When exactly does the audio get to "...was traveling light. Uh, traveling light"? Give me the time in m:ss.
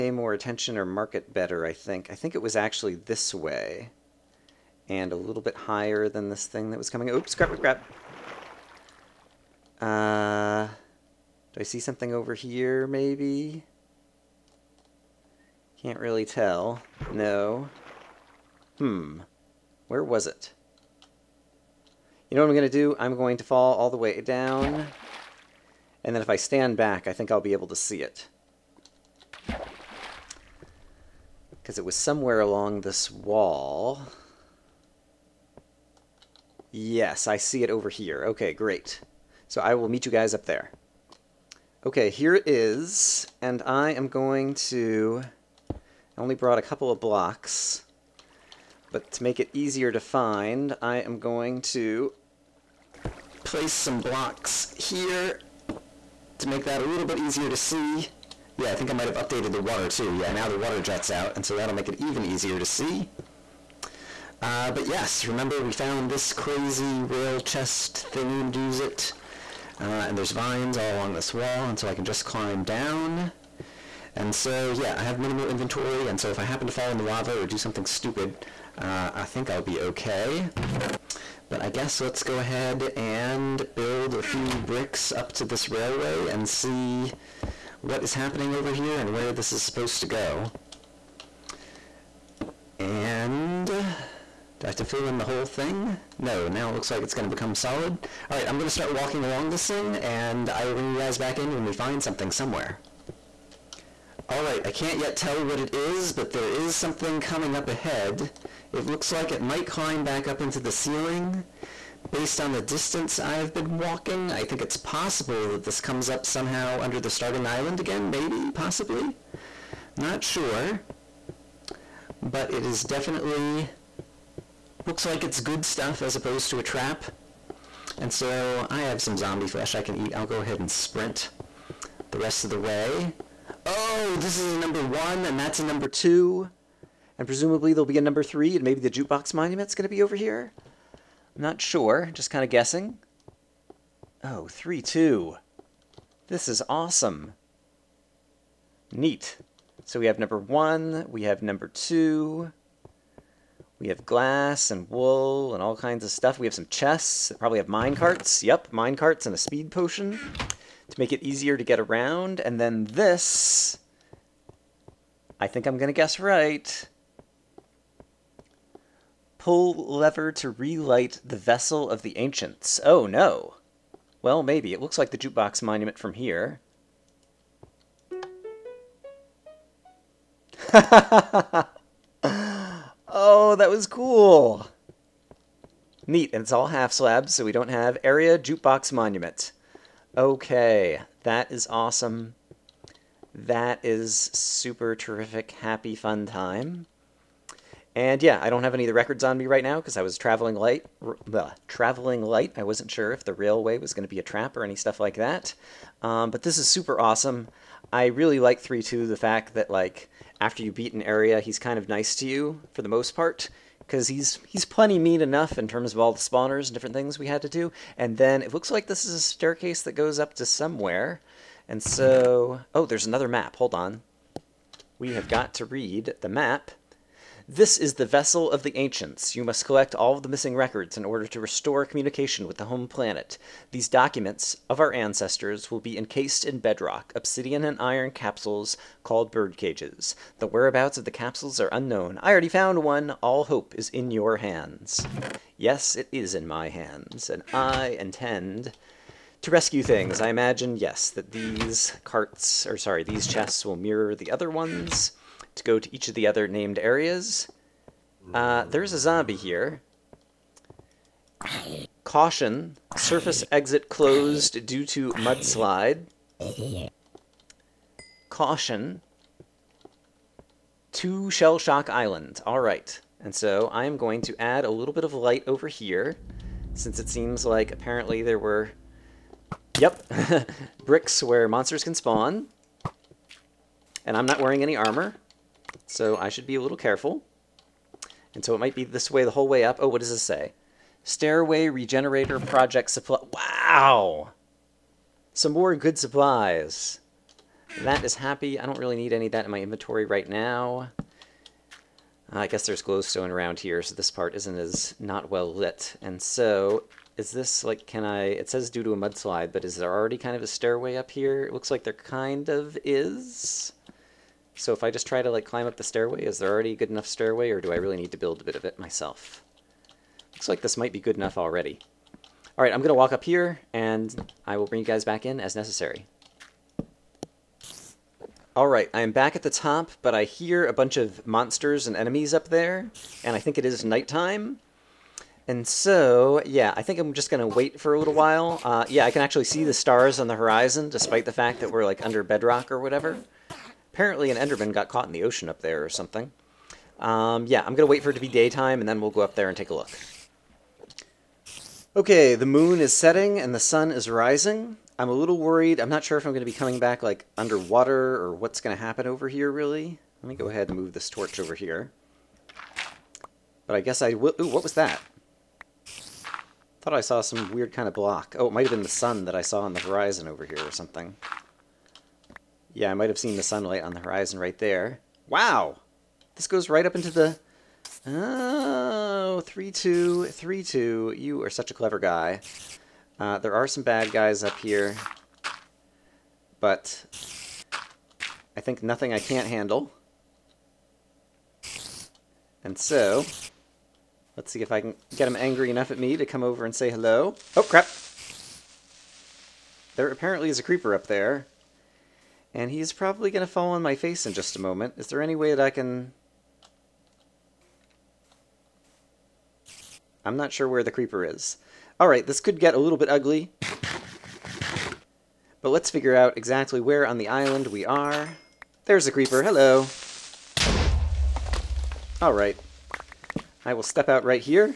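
3:20.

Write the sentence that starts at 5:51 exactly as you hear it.
Okay, the moon is setting and the sun is rising.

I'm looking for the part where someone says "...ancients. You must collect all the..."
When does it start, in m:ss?
3:48.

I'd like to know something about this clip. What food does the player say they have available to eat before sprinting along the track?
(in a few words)
Zombie flesh.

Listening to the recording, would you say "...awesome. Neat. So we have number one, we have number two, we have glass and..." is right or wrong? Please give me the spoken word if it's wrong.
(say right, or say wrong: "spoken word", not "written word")
right.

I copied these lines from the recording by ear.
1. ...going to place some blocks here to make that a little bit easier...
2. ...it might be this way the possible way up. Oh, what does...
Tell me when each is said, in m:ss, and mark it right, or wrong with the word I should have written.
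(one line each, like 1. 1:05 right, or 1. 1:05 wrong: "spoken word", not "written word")
1. 0:51 right
2. 4:48 wrong: "whole", not "possible".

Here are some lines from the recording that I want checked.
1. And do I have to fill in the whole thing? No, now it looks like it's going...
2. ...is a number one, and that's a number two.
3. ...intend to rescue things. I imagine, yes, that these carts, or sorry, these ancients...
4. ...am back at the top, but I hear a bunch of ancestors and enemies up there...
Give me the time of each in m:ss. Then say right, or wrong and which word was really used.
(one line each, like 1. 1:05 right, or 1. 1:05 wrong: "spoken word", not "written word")
1. 1:32 right
2. 2:14 right
3. 4:07 wrong: "chests", not "ancients"
4. 5:29 wrong: "monsters", not "ancestors".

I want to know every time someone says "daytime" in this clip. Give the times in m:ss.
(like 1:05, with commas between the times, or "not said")
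5:48.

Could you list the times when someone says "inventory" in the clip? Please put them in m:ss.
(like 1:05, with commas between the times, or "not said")
1:15, 4:59.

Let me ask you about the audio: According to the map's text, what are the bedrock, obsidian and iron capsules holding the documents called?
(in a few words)
Bird cages.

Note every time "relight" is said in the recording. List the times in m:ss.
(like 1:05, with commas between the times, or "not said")
2:50.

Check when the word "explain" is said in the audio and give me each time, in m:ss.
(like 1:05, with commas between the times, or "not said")
not said.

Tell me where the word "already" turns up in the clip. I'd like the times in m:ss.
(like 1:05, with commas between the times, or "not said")
4:02, 5:09, 5:16, 5:21.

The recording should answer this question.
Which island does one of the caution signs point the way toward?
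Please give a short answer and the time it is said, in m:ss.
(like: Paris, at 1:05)
Shell Shock Island, at 4:31.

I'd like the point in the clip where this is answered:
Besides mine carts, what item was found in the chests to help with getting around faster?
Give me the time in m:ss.
2:39.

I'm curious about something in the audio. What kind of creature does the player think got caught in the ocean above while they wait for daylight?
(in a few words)
An Enderman.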